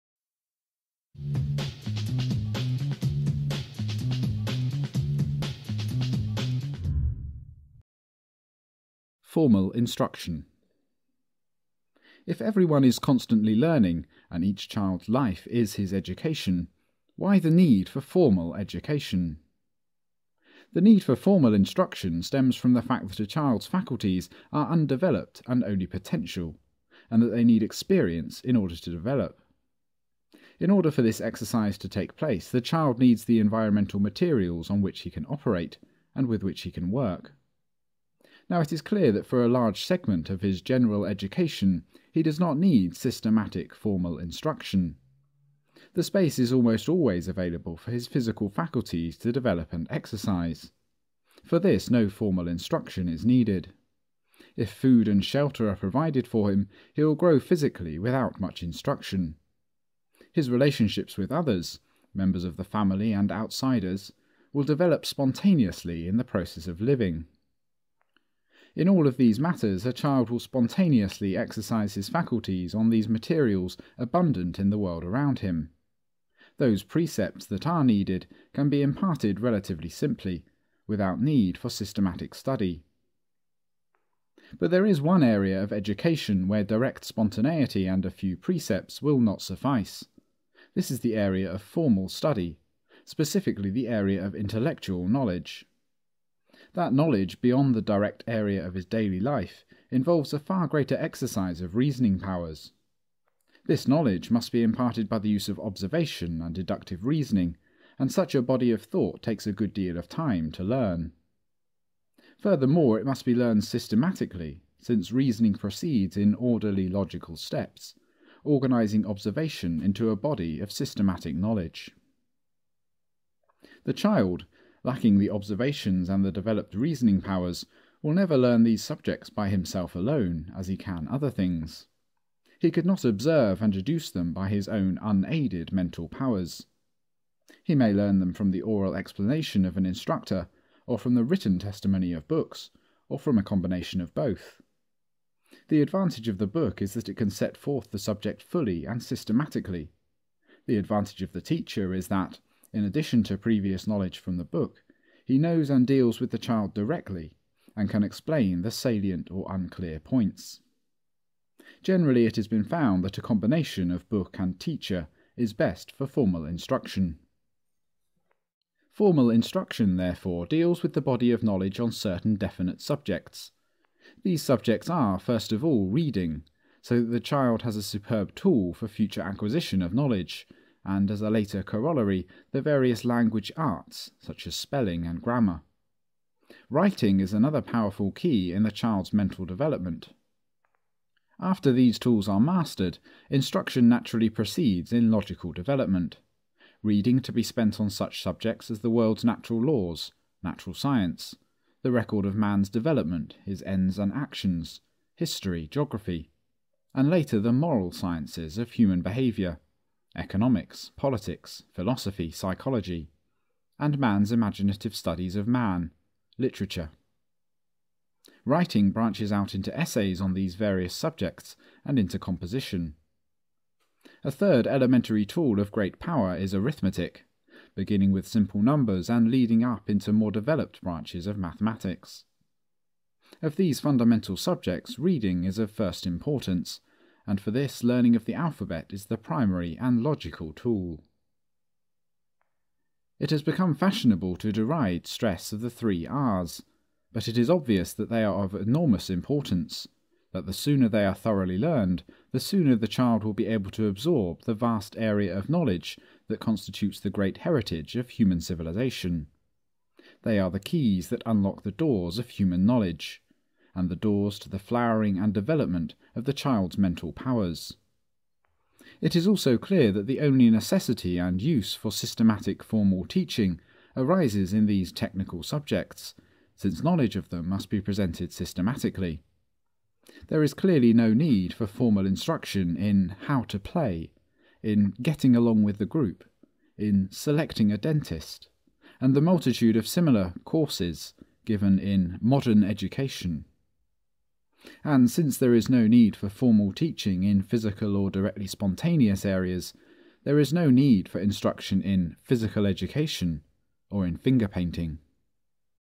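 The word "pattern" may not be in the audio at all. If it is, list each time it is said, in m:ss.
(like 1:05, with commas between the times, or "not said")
not said.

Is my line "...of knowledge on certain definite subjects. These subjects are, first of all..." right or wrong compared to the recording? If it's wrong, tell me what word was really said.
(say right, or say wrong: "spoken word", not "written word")
right.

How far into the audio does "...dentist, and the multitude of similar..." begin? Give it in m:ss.
4:47.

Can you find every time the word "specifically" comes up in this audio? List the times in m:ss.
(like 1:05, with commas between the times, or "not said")
1:33.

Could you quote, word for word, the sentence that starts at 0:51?
For this no formal instruction is needed.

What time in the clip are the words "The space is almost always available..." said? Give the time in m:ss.
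0:45.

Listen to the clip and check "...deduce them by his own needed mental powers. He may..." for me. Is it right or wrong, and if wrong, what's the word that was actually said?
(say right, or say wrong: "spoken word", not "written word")
wrong: "unaided", not "needed".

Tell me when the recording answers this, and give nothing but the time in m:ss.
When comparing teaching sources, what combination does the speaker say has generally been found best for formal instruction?
2:44.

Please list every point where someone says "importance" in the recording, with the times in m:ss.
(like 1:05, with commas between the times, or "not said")
3:56, 4:09.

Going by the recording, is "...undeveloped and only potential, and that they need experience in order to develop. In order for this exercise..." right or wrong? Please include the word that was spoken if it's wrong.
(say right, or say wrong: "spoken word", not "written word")
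right.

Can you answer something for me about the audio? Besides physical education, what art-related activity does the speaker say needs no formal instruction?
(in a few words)
finger painting.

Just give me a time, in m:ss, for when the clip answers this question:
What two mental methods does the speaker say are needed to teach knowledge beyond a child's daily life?
1:45.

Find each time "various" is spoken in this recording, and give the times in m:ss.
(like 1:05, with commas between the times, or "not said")
3:02, 3:40.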